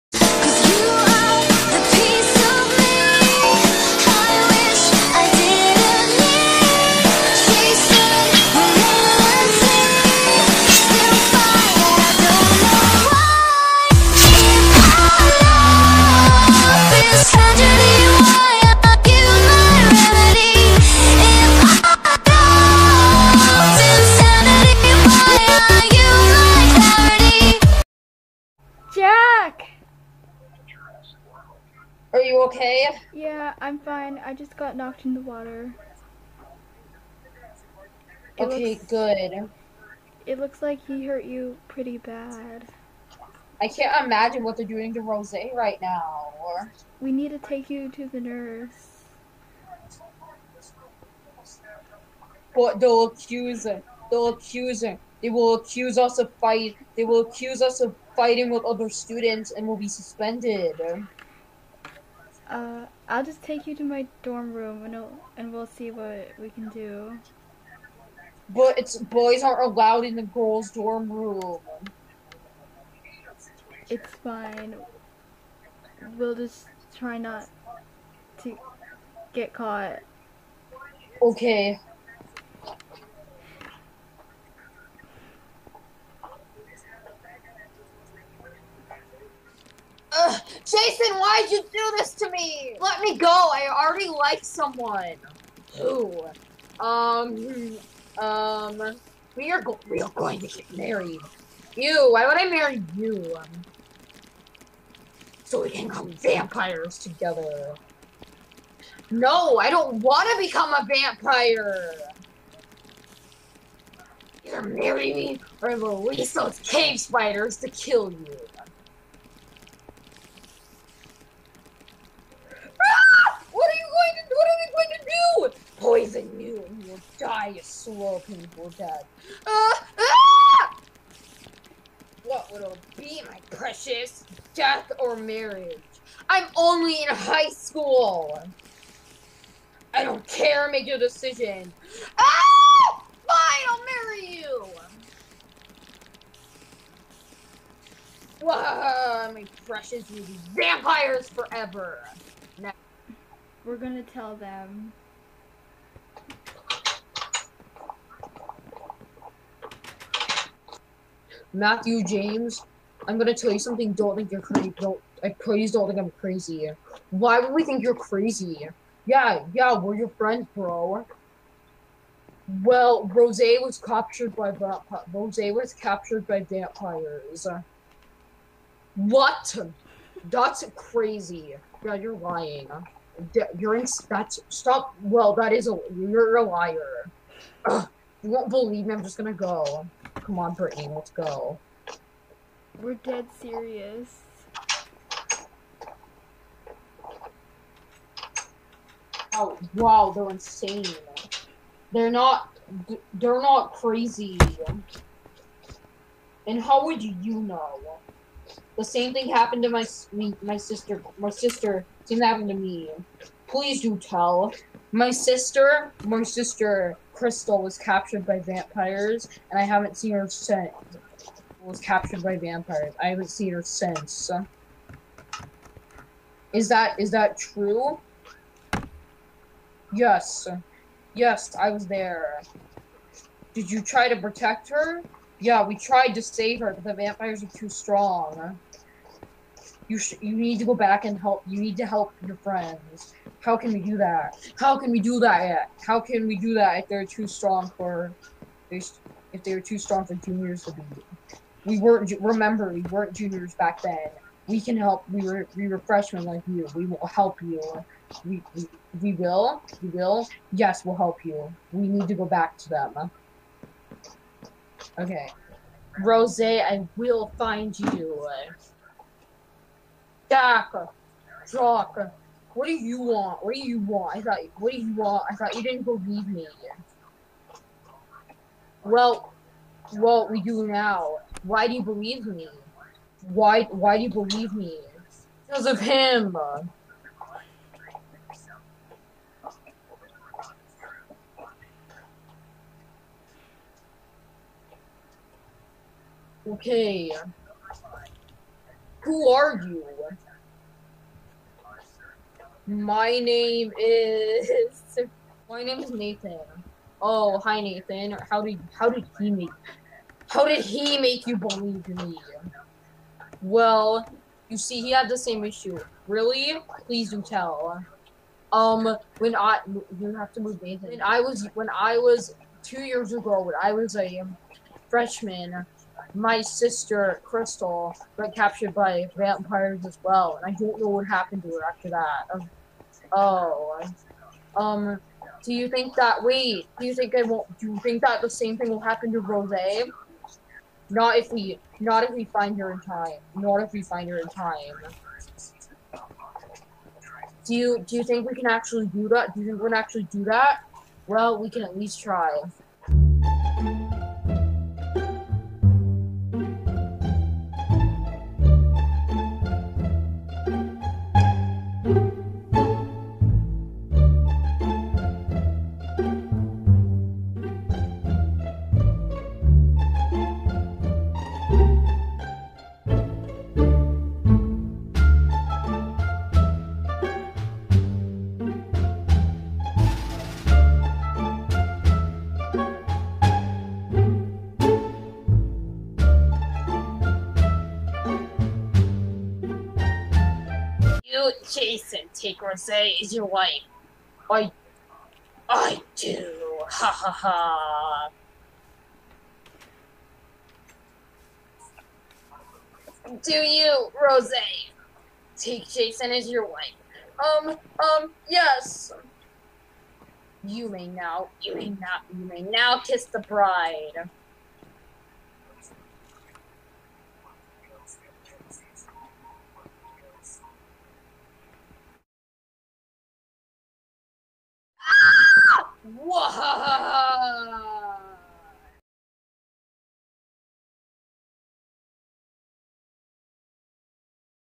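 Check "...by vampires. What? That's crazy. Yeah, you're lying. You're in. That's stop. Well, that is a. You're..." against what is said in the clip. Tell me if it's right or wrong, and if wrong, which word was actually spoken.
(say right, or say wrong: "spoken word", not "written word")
right.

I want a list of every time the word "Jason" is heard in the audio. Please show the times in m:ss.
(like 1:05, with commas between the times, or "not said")
1:30, 6:31, 6:45.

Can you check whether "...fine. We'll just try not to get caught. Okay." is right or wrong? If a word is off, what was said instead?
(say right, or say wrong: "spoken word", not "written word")
right.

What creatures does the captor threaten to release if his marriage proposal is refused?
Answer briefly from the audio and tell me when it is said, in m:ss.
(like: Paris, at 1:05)
cave spiders, at 1:56.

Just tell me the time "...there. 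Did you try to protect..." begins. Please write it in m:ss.
3:51.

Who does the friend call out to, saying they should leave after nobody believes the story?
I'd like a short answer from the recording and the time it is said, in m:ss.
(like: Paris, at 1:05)
Brittany, at 3:10.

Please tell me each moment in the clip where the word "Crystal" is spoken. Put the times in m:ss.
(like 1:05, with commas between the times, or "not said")
3:37, 5:27.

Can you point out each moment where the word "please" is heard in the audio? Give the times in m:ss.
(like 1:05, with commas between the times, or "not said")
2:45, 3:33, 5:16.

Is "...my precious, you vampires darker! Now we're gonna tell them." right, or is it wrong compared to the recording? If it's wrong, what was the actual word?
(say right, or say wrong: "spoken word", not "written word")
wrong: "forever", not "darker".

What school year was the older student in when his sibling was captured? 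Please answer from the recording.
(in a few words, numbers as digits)
freshman.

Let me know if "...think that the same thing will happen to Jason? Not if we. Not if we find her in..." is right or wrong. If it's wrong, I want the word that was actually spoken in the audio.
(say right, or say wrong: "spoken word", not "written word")
wrong: "Rose", not "Jason".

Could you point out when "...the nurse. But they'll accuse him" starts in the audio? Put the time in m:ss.
0:48.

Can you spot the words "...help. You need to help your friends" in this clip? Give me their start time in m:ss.
4:01.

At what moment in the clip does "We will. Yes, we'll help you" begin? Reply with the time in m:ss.
4:19.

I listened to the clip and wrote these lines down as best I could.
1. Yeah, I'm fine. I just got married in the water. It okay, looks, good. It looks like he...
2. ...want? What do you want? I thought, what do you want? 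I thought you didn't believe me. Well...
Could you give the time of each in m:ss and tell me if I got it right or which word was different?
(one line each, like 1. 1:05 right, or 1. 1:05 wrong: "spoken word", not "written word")
1. 0:33 wrong: "knocked", not "married"
2. 4:32 right.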